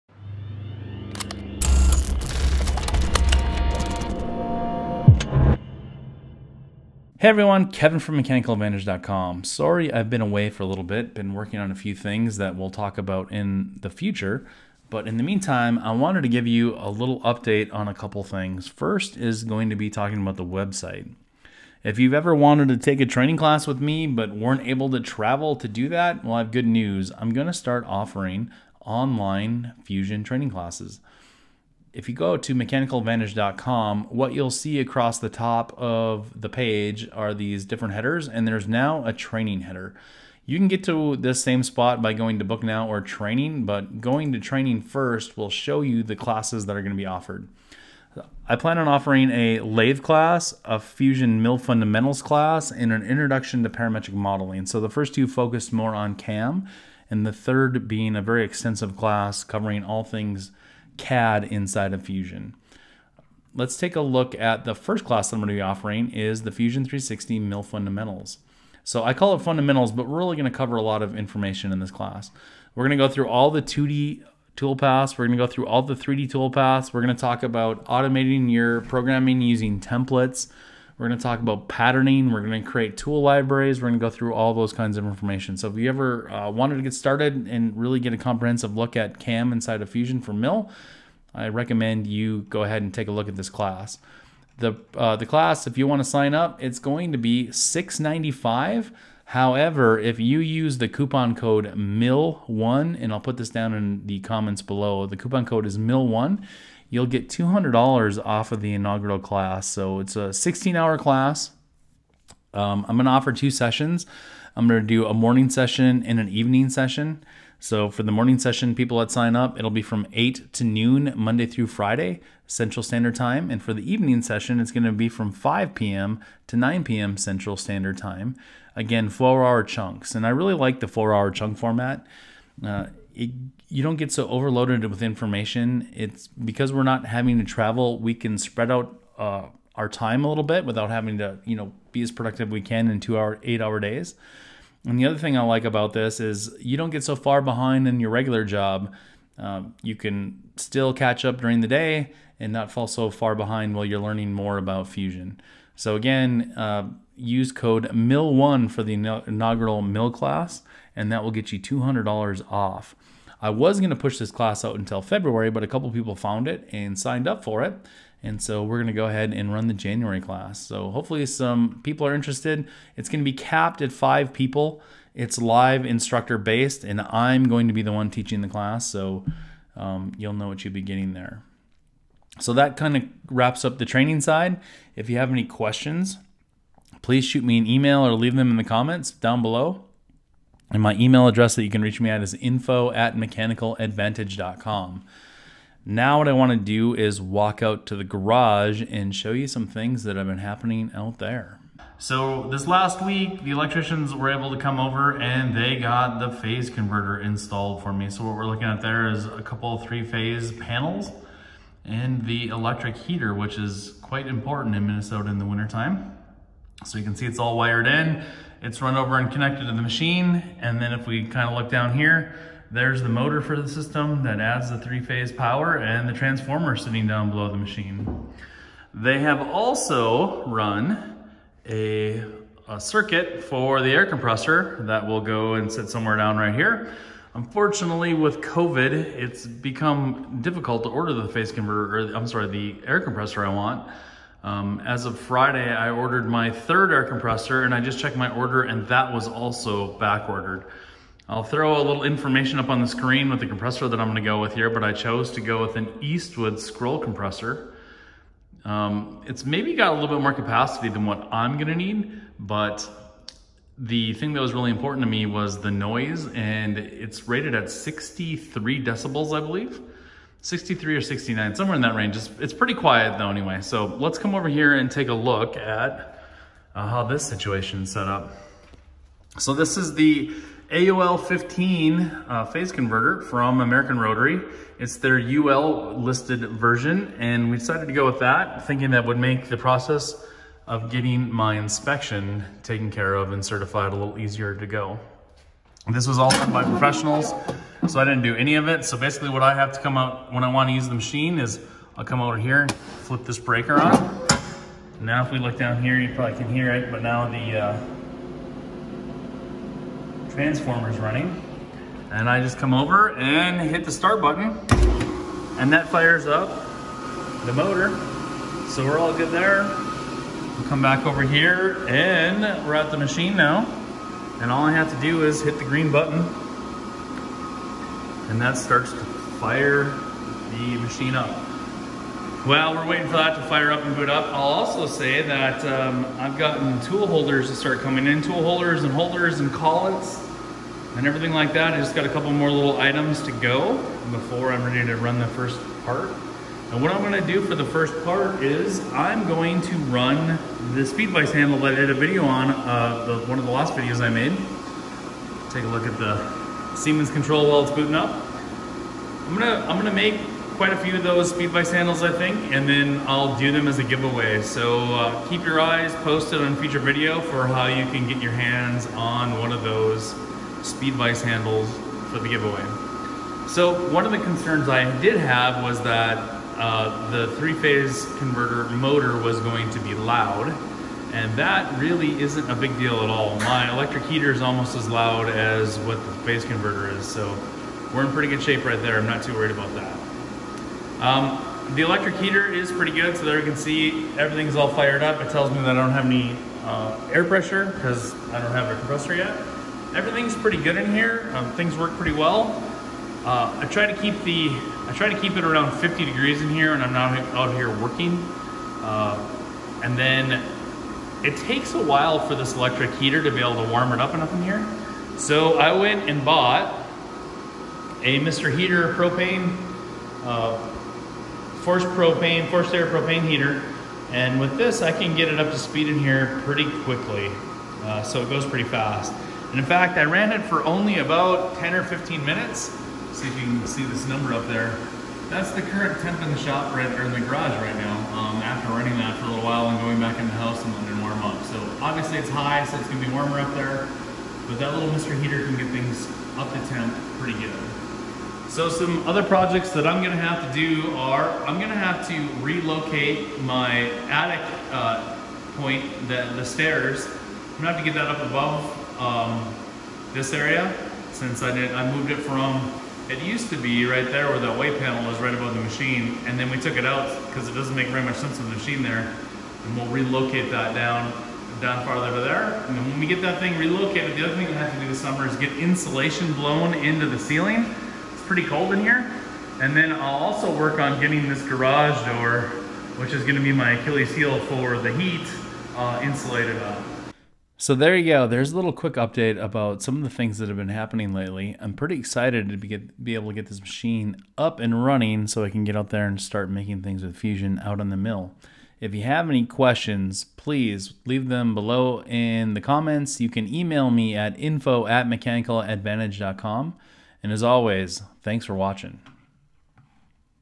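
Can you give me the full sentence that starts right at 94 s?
The, uh, the class, if you want to sign up, it's going to be $6.95.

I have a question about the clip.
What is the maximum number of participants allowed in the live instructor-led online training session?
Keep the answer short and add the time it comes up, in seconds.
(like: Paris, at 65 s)
5, at 173 s.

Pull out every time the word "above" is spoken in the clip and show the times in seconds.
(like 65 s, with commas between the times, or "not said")
458 s, 465 s.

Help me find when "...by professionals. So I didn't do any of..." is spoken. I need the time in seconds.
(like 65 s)
296 s.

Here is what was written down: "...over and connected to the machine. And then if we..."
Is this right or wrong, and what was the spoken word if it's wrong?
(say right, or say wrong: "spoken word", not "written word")
right.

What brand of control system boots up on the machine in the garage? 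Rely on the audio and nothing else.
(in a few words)
Siemens.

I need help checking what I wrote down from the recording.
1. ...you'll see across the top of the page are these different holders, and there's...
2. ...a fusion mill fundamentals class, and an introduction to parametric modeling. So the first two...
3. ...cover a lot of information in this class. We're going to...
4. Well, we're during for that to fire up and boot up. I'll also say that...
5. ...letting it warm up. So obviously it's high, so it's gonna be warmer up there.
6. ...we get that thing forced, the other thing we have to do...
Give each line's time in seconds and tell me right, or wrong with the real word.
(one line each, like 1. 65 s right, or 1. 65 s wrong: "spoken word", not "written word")
1. 34 s wrong: "headers", not "holders"
2. 50 s right
3. 70 s right
4. 332 s wrong: "waiting", not "during"
5. 440 s right
6. 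473 s wrong: "relocated", not "forced".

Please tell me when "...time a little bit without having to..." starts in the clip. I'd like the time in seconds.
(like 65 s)
139 s.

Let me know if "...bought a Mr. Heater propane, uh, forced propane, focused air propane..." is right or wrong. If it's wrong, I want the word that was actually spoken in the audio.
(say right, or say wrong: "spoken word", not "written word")
wrong: "forced", not "focused".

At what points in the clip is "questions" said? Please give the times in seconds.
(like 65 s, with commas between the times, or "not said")
185 s, 499 s.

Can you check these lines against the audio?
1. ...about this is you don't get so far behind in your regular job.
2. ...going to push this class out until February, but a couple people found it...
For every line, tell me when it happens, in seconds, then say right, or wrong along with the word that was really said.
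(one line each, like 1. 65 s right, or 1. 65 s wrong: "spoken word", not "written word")
1. 145 s right
2. 163 s right.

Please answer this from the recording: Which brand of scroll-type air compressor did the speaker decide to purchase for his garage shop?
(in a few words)
Eastwood.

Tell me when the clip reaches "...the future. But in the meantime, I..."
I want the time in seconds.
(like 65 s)
13 s.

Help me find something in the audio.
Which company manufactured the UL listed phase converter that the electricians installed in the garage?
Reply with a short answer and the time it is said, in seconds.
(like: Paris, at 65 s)
American Rotary, at 283 s.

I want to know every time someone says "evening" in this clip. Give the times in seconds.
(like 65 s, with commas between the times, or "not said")
116 s, 123 s.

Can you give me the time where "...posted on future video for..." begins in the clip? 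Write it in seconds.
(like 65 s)
365 s.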